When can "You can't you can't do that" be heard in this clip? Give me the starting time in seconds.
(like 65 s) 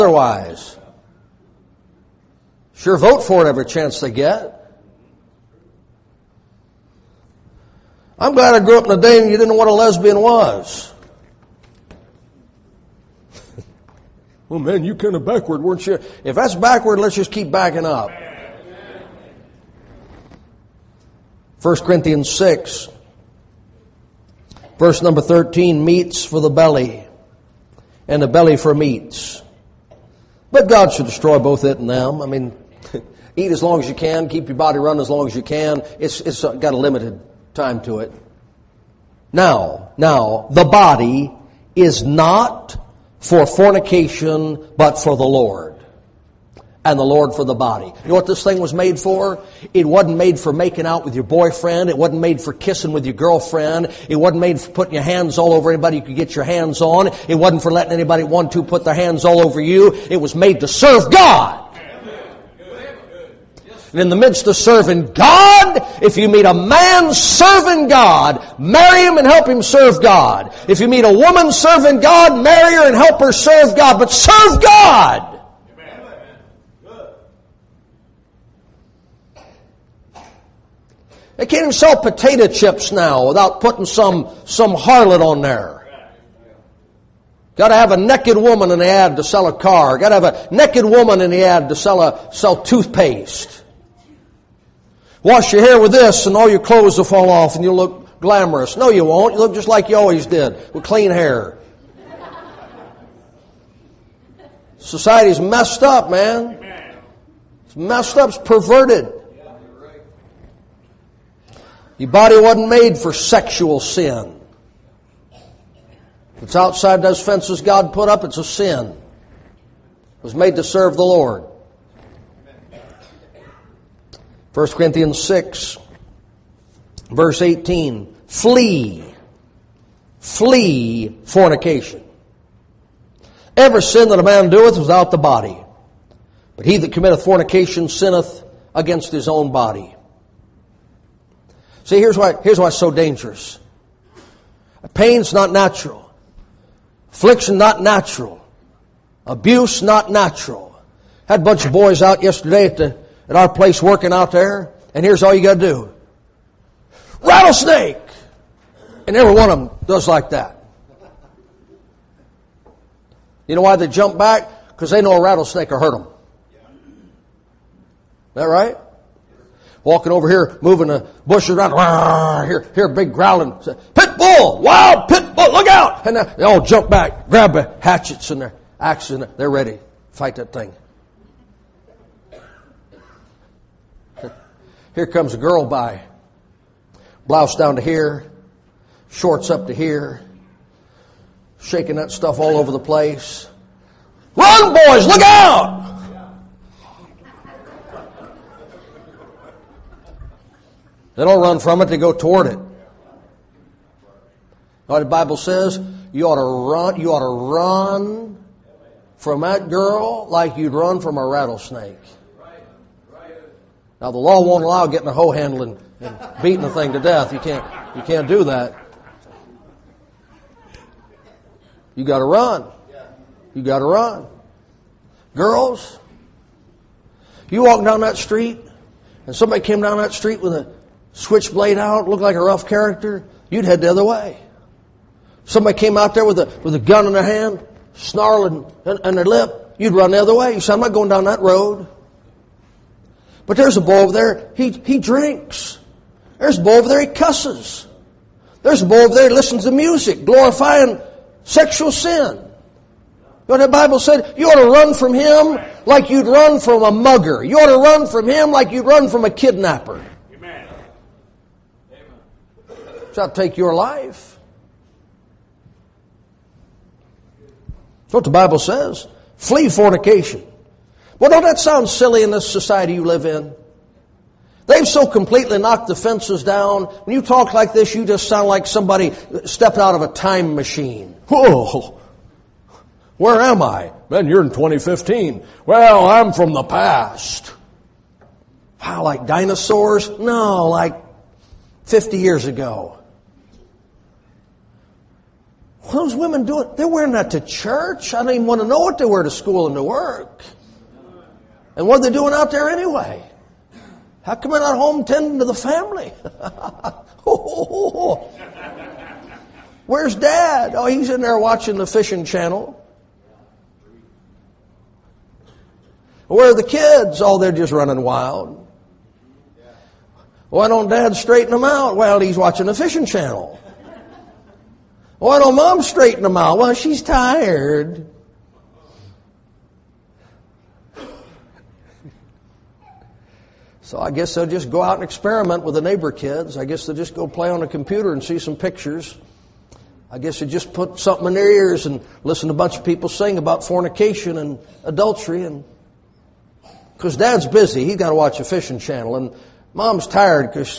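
217 s.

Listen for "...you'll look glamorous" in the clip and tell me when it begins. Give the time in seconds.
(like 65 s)
97 s.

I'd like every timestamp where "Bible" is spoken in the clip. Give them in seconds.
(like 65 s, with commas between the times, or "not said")
205 s, 253 s, 268 s.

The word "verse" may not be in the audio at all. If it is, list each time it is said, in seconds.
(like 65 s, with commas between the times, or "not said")
24 s, 127 s.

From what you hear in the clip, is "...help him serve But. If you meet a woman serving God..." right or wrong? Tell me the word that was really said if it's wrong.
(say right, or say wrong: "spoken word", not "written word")
wrong: "God", not "But".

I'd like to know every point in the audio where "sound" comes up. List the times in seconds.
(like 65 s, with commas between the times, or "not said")
271 s, 278 s.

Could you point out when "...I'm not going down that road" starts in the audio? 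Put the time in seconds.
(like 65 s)
240 s.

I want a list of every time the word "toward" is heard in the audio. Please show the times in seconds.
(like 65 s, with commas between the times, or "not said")
202 s.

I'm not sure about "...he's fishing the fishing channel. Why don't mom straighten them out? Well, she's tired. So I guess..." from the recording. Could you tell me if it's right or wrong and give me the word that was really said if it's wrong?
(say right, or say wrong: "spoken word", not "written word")
wrong: "watching", not "fishing".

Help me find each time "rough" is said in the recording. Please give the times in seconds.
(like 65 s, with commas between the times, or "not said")
232 s.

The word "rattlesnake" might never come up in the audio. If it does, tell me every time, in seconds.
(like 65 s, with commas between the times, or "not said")
157 s, 165 s, 211 s.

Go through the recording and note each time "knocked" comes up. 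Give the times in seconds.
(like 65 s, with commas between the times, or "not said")
275 s.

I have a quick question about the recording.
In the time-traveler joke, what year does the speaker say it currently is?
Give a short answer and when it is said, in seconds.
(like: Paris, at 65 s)
2015, at 284 s.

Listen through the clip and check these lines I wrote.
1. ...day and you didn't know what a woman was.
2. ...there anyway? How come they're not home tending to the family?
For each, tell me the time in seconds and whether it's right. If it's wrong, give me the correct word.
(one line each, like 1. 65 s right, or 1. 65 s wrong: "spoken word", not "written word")
1. 9 s wrong: "lesbian", not "woman"
2. 302 s right.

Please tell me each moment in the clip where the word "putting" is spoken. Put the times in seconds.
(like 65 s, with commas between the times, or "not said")
54 s, 83 s.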